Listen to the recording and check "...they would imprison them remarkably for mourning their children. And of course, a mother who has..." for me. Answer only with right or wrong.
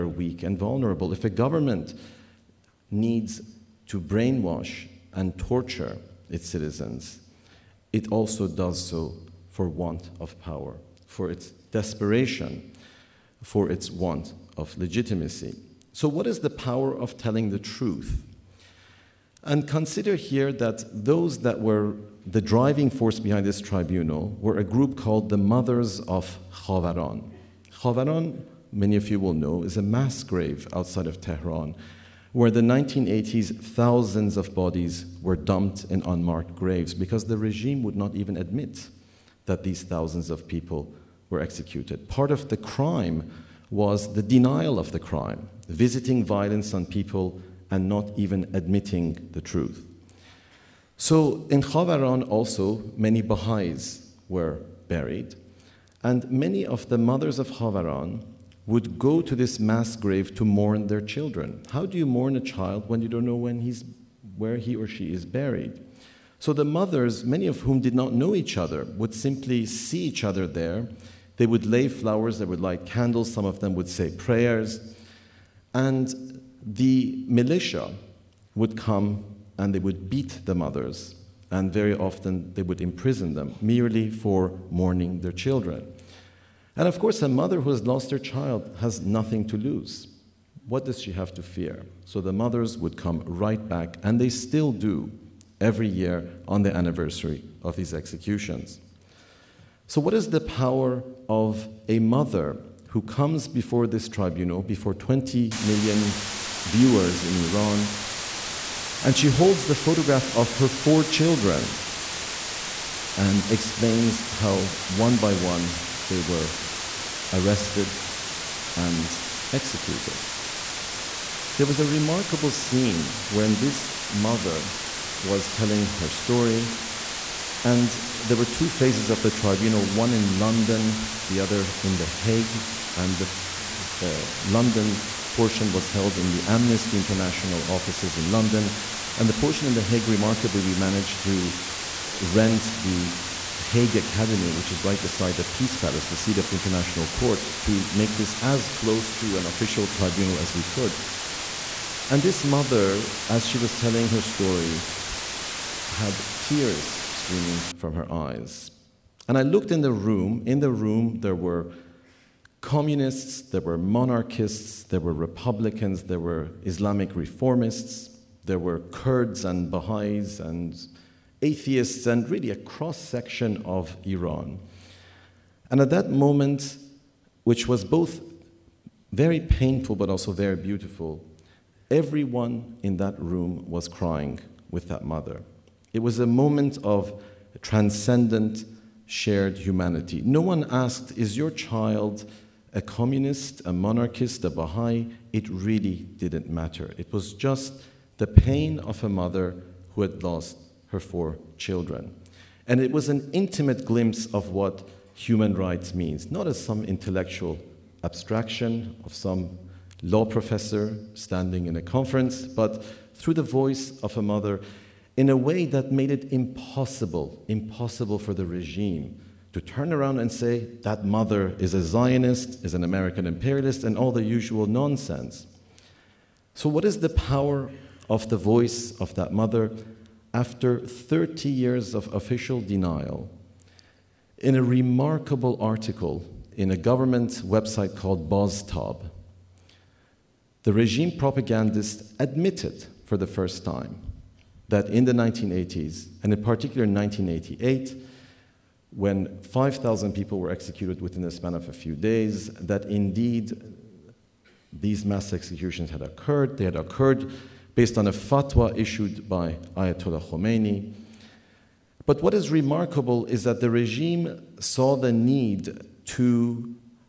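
wrong.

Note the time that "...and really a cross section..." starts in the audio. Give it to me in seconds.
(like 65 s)
172 s.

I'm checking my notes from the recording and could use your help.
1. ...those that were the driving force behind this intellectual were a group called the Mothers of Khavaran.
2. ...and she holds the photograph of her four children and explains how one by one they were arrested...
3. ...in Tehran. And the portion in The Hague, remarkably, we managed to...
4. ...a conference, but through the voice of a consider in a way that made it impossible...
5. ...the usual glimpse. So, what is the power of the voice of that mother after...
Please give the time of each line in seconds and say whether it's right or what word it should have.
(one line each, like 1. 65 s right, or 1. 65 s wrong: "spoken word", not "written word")
1. 21 s wrong: "tribunal", not "intellectual"
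2. 109 s right
3. 138 s wrong: "London", not "Tehran"
4. 211 s wrong: "mother", not "consider"
5. 224 s wrong: "nonsense", not "glimpse".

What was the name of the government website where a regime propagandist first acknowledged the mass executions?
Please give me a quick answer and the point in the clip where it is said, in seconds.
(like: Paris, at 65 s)
Baztab, at 238 s.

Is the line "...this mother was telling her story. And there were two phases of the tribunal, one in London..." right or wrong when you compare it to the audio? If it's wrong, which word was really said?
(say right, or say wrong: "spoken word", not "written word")
right.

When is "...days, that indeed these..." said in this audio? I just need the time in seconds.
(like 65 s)
251 s.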